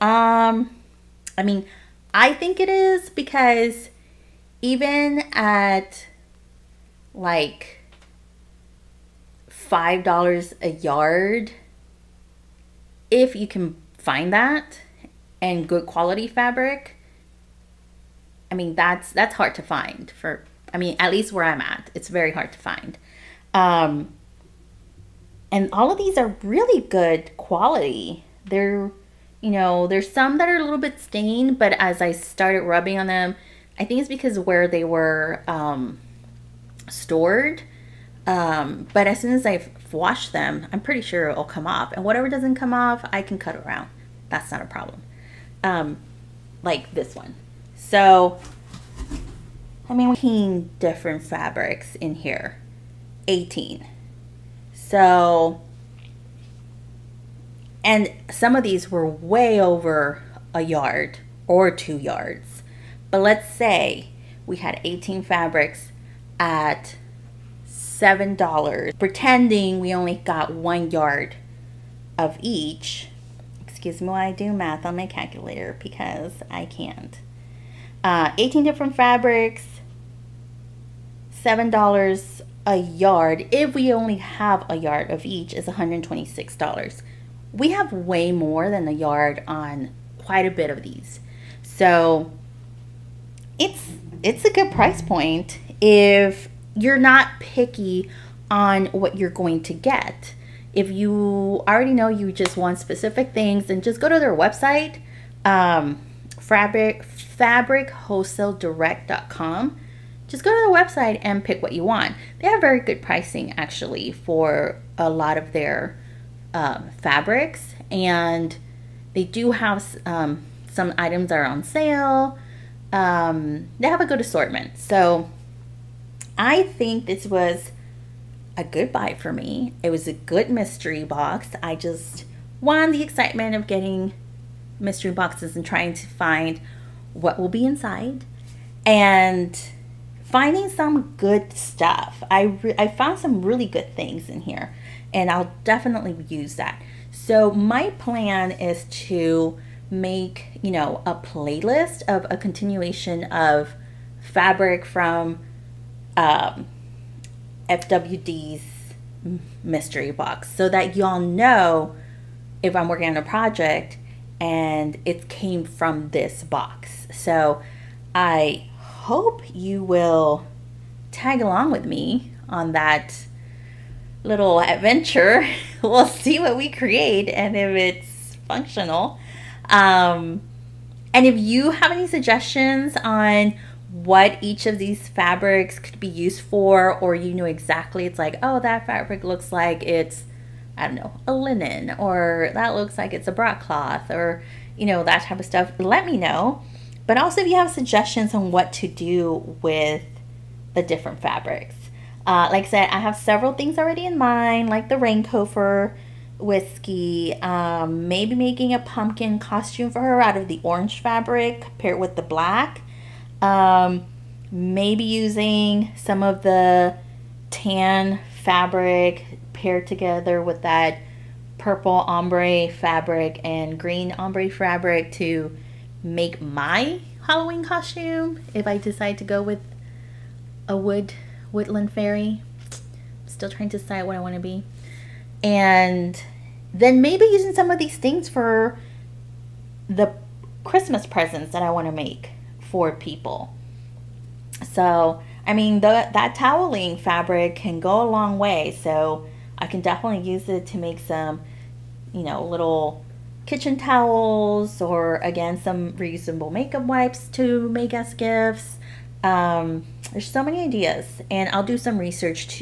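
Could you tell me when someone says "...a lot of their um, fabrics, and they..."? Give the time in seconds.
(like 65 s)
114 s.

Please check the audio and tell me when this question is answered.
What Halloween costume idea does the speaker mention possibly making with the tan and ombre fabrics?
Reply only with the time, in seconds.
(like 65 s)
231 s.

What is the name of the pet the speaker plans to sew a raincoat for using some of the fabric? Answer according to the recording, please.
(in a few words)
Whiskey.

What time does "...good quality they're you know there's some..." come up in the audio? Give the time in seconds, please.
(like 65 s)
26 s.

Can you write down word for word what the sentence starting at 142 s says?
I, I found some really good things in here and I'll definitely use that.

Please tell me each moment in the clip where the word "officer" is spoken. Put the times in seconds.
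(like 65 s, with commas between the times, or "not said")
not said.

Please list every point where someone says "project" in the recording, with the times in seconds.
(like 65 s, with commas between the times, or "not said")
163 s.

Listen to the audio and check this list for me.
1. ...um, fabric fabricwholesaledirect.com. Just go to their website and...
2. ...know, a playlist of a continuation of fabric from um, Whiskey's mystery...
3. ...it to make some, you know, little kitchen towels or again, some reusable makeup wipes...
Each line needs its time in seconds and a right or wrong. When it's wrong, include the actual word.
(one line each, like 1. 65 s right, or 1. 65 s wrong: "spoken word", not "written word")
1. 105 s right
2. 150 s wrong: "FWD", not "Whiskey"
3. 250 s right.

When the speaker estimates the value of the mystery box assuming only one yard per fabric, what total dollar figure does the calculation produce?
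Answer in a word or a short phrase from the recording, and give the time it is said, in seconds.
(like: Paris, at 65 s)
$126, at 85 s.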